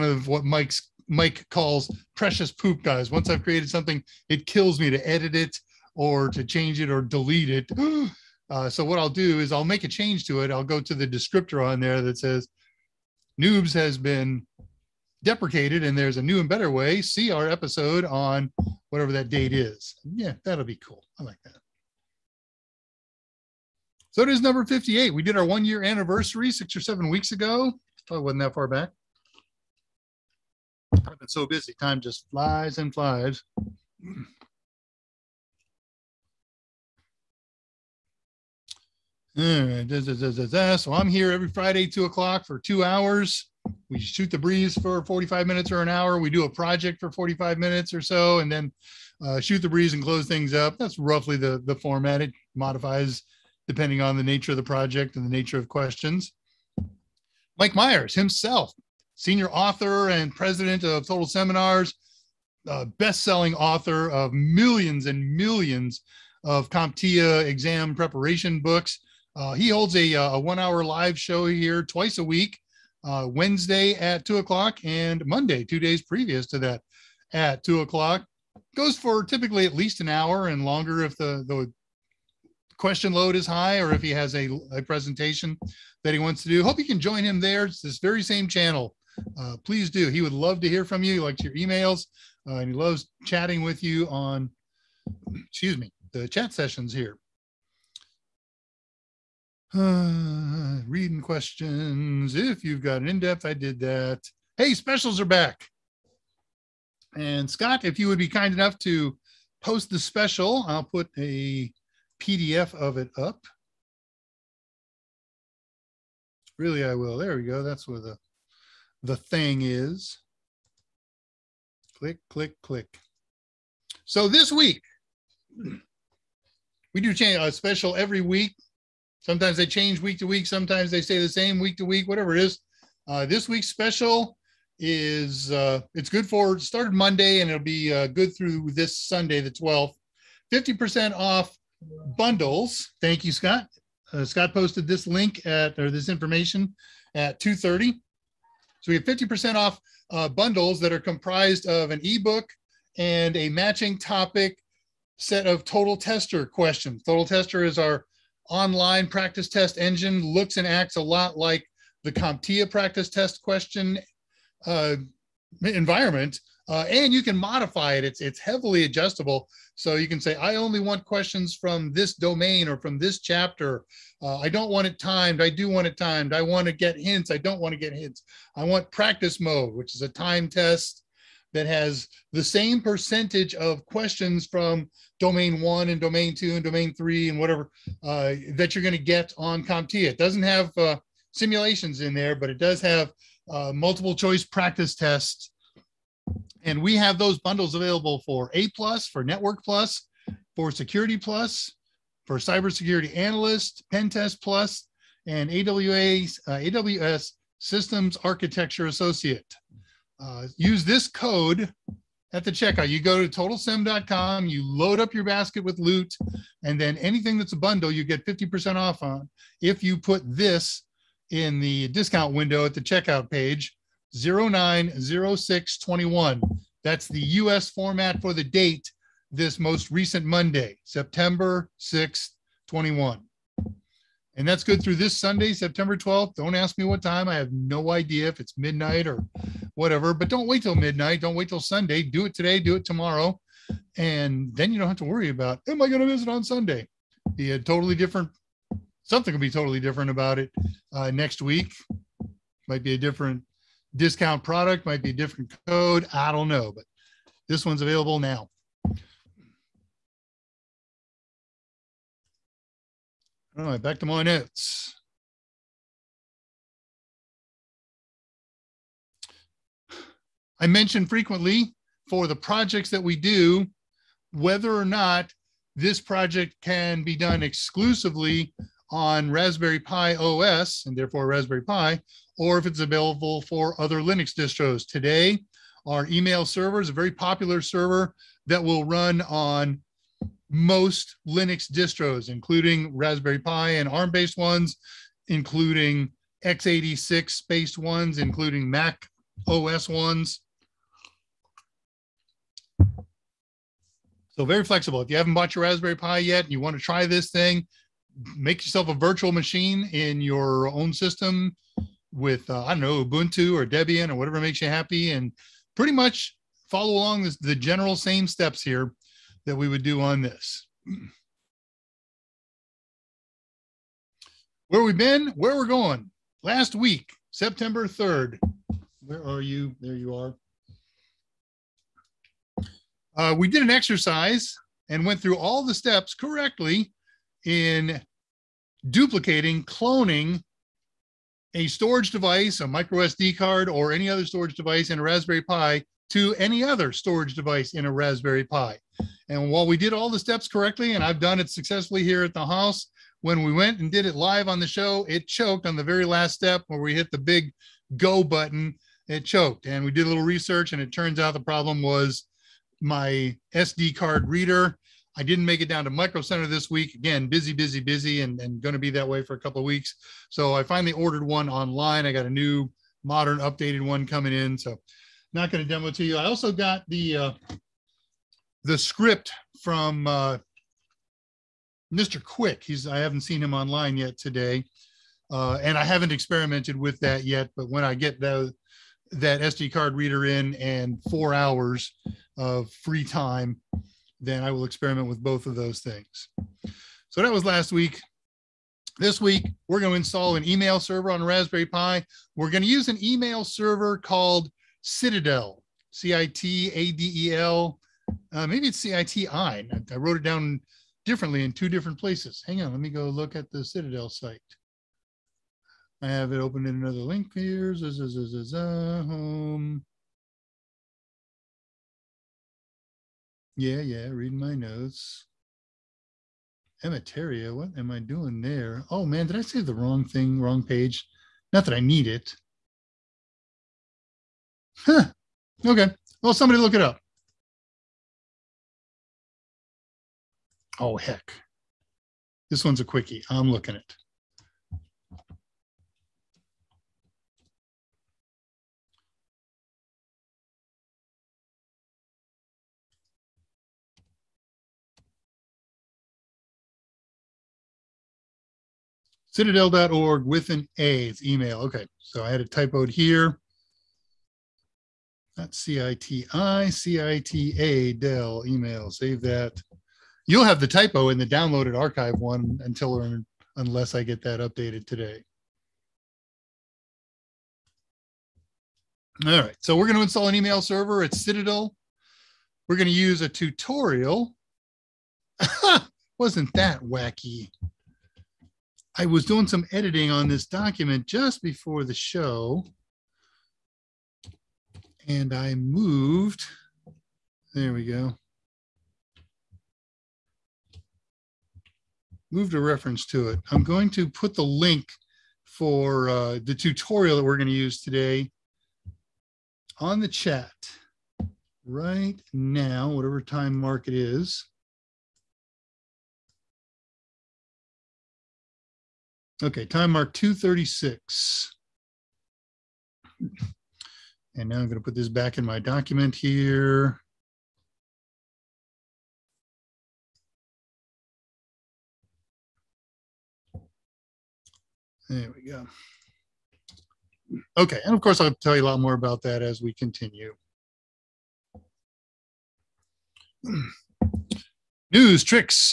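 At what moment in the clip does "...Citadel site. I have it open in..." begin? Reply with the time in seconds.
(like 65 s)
413 s.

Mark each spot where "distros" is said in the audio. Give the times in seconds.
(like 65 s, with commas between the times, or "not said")
284 s, 291 s.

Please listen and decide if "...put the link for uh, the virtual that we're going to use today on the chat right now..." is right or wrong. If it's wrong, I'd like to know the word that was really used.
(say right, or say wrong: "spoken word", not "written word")
wrong: "tutorial", not "virtual".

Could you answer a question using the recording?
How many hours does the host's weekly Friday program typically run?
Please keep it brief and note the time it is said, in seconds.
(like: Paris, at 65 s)
two hours, at 42 s.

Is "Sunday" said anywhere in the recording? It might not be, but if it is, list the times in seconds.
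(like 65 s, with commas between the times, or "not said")
138 s, 235 s, 241 s, 246 s.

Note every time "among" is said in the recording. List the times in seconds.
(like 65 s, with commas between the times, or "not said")
not said.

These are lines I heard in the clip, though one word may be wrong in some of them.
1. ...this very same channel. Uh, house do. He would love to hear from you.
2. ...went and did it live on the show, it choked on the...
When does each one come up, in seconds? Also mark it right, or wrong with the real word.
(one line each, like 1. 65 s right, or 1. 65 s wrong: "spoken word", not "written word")
1. 87 s wrong: "please", not "house"
2. 353 s right.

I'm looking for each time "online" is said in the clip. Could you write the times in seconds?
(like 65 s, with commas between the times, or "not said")
158 s, 371 s, 383 s.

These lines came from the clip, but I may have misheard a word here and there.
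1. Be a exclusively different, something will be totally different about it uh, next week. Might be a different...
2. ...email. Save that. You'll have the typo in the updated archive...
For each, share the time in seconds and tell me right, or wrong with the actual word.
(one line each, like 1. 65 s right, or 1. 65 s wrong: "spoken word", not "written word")
1. 247 s wrong: "totally", not "exclusively"
2. 468 s wrong: "downloaded", not "updated".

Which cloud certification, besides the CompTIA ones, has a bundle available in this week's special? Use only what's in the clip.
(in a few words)
AWS Systems Architecture Associate.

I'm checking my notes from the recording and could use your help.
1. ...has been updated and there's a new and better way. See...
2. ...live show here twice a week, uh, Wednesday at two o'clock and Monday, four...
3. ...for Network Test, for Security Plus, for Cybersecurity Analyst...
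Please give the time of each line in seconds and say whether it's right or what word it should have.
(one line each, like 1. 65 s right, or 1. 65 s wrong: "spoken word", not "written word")
1. 13 s wrong: "deprecated", not "updated"
2. 70 s wrong: "two", not "four"
3. 199 s wrong: "Plus", not "Test".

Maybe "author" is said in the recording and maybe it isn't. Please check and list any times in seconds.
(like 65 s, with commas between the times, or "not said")
59 s, 63 s.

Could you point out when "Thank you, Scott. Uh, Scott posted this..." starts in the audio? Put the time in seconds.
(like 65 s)
142 s.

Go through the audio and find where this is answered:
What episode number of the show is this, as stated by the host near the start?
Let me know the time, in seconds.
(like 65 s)
24 s.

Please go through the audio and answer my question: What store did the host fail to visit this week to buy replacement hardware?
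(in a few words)
Micro Center.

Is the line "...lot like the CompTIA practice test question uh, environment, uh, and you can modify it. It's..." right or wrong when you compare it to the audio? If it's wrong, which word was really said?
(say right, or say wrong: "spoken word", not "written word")
right.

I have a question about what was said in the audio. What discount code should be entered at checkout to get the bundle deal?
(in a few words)
090621.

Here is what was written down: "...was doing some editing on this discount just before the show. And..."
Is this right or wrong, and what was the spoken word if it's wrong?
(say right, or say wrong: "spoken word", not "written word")
wrong: "document", not "discount".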